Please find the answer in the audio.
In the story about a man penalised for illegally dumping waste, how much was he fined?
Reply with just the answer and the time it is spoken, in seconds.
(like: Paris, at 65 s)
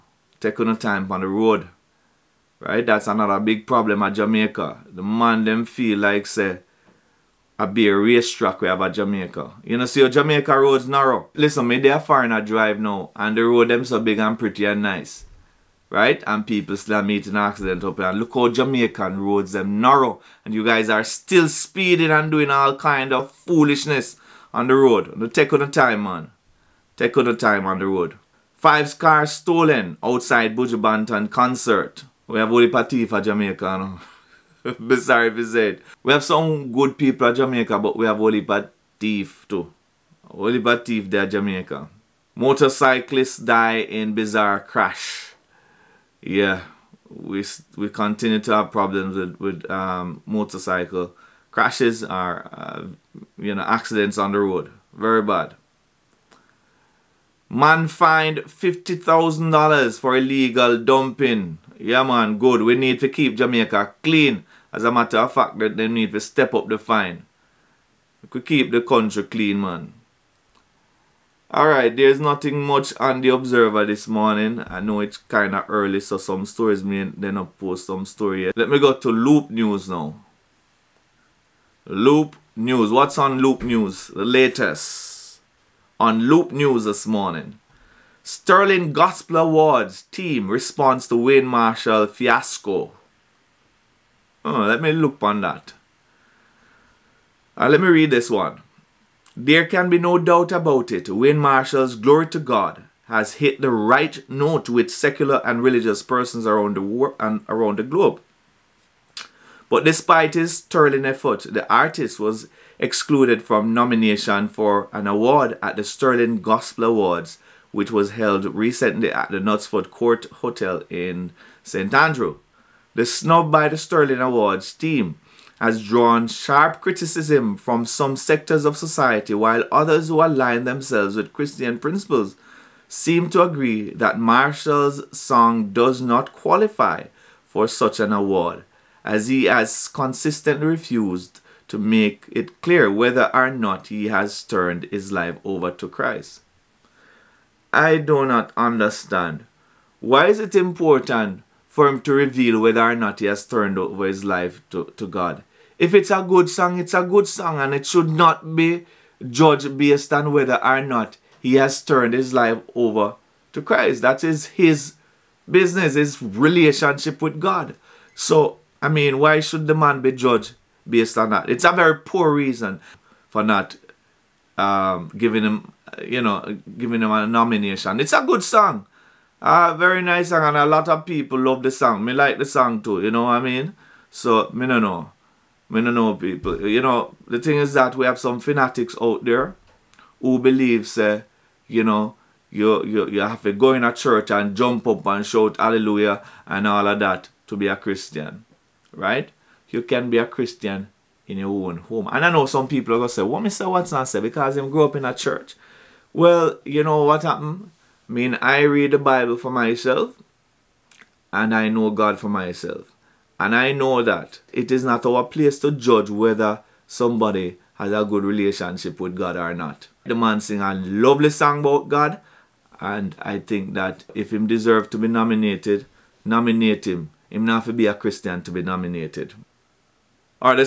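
$50,000, at 58 s.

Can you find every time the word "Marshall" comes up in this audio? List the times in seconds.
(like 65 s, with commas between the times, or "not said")
91 s, 101 s, 134 s.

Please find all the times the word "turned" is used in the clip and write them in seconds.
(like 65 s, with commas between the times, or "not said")
144 s, 153 s, 161 s.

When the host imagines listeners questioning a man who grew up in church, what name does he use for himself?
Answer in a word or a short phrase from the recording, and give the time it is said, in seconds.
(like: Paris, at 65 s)
Mr. Watson, at 203 s.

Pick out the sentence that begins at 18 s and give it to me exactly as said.
And look how Jamaican roads them narrow.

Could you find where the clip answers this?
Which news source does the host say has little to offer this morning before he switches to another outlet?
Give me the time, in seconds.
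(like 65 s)
73 s.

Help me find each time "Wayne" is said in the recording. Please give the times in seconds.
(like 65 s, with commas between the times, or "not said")
91 s, 101 s.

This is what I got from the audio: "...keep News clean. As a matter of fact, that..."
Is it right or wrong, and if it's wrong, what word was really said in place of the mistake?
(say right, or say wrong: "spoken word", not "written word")
wrong: "Jamaica", not "News".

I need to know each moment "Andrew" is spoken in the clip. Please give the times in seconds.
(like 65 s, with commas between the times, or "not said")
121 s.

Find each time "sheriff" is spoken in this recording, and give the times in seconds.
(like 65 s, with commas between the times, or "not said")
not said.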